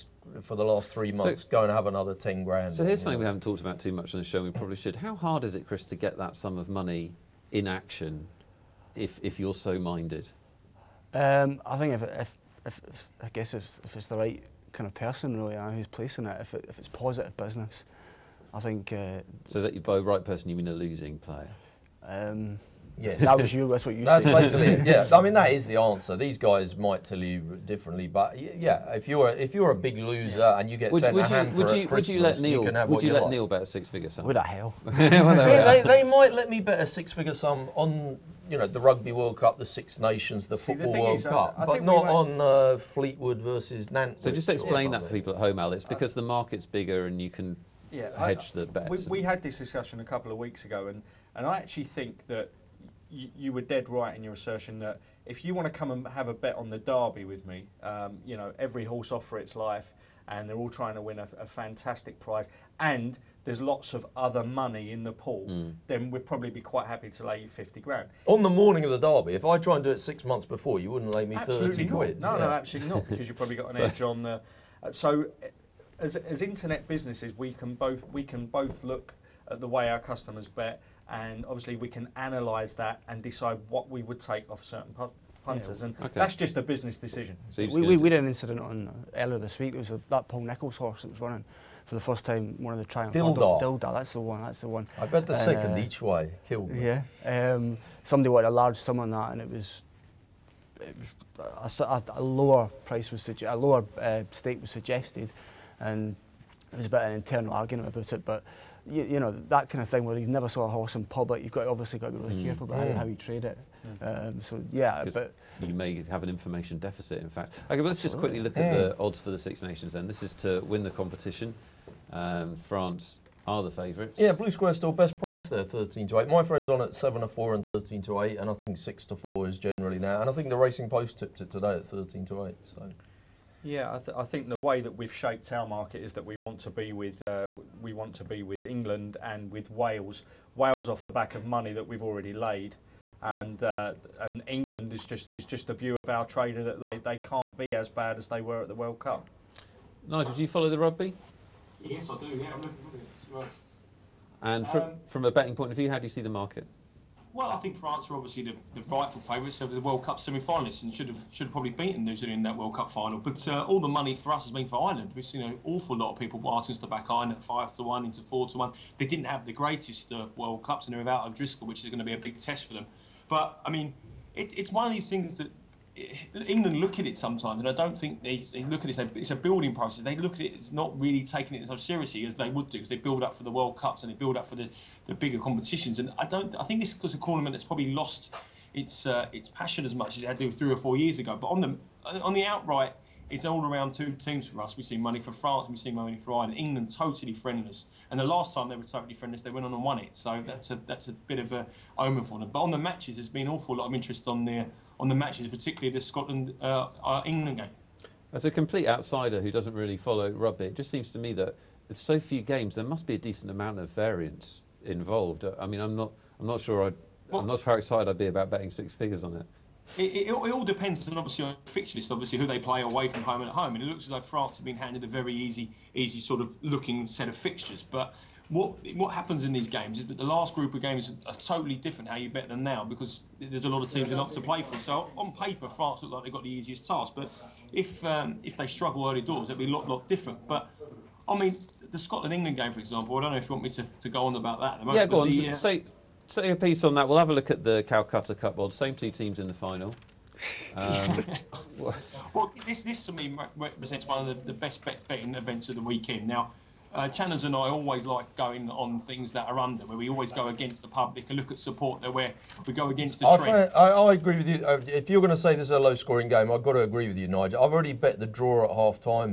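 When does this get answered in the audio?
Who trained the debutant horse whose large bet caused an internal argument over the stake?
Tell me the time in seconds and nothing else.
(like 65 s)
90 s.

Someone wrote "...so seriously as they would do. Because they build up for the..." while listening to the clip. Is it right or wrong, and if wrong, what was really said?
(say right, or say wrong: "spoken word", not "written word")
right.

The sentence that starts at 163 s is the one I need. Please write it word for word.
But uh, all the money for us has been for Ireland.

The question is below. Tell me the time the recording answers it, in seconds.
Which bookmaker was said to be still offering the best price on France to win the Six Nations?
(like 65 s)
124 s.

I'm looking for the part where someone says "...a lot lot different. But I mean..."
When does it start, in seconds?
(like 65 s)
239 s.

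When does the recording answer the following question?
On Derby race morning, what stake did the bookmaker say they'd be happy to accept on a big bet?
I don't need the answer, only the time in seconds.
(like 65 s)
67 s.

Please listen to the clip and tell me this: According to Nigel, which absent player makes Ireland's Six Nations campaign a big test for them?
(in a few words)
O'Driscoll.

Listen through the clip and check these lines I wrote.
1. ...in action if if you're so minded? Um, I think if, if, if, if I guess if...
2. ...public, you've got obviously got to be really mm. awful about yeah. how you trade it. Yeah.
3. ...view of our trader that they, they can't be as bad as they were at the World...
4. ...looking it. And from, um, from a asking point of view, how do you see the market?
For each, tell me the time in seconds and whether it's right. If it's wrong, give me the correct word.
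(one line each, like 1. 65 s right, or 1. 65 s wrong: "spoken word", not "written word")
1. 7 s right
2. 111 s wrong: "careful", not "awful"
3. 145 s right
4. 152 s wrong: "betting", not "asking".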